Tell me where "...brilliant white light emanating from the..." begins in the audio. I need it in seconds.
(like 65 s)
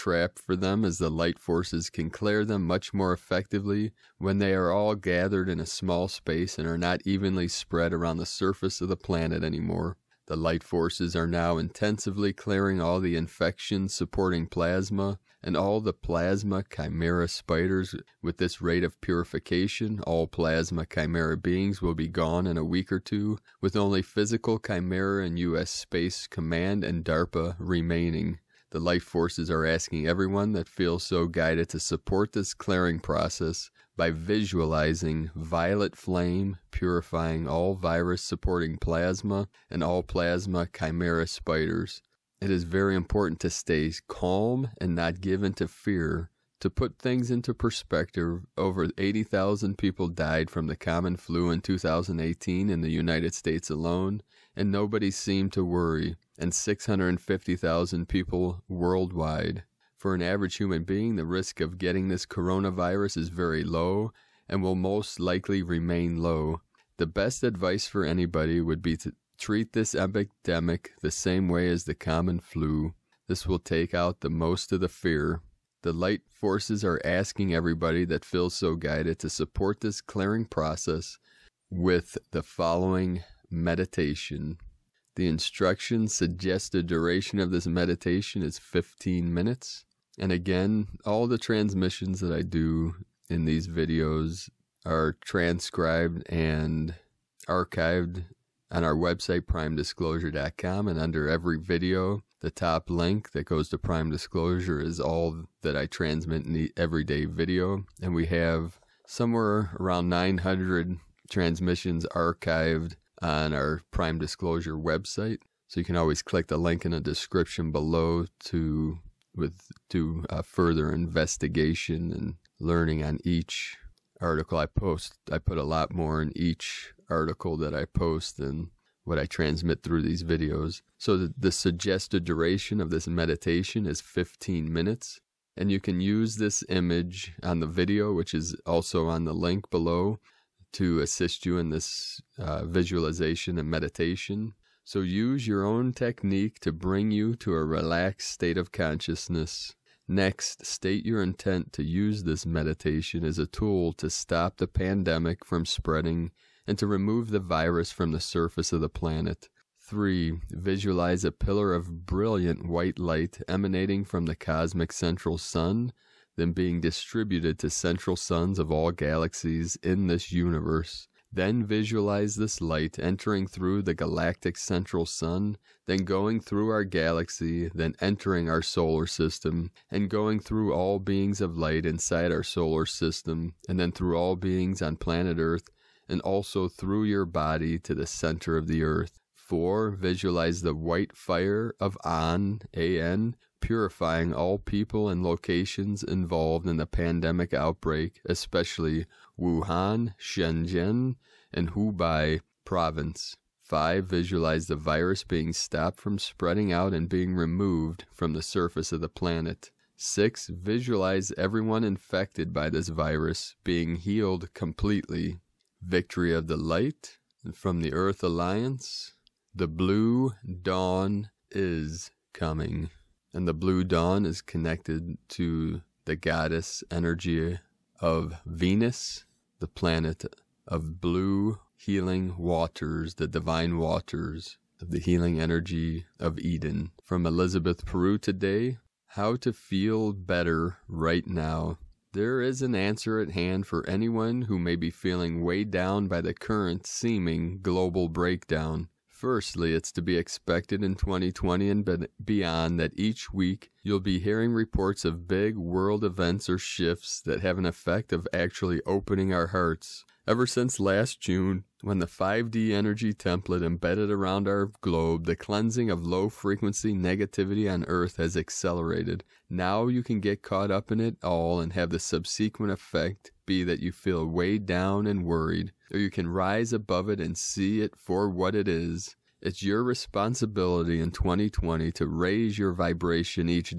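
162 s.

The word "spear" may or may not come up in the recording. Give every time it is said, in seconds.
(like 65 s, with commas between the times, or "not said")
not said.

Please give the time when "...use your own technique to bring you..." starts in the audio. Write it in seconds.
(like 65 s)
144 s.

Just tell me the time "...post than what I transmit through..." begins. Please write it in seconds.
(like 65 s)
127 s.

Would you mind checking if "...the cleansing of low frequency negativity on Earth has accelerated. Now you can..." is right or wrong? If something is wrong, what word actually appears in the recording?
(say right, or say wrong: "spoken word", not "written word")
right.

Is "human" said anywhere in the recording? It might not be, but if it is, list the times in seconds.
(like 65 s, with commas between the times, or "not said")
60 s.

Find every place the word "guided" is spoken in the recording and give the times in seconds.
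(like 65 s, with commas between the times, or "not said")
31 s, 78 s.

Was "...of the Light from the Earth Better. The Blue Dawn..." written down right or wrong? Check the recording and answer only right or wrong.
wrong.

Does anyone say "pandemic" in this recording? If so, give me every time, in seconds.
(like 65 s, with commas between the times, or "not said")
154 s, 196 s.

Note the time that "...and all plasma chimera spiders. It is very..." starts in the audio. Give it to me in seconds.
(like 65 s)
39 s.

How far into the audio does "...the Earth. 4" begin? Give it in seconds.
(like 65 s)
188 s.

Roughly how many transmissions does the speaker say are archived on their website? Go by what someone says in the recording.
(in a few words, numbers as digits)
900.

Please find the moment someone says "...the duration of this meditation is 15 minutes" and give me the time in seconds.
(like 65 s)
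86 s.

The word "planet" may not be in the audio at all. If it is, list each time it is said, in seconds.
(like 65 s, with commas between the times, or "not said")
8 s, 158 s, 184 s, 209 s, 229 s.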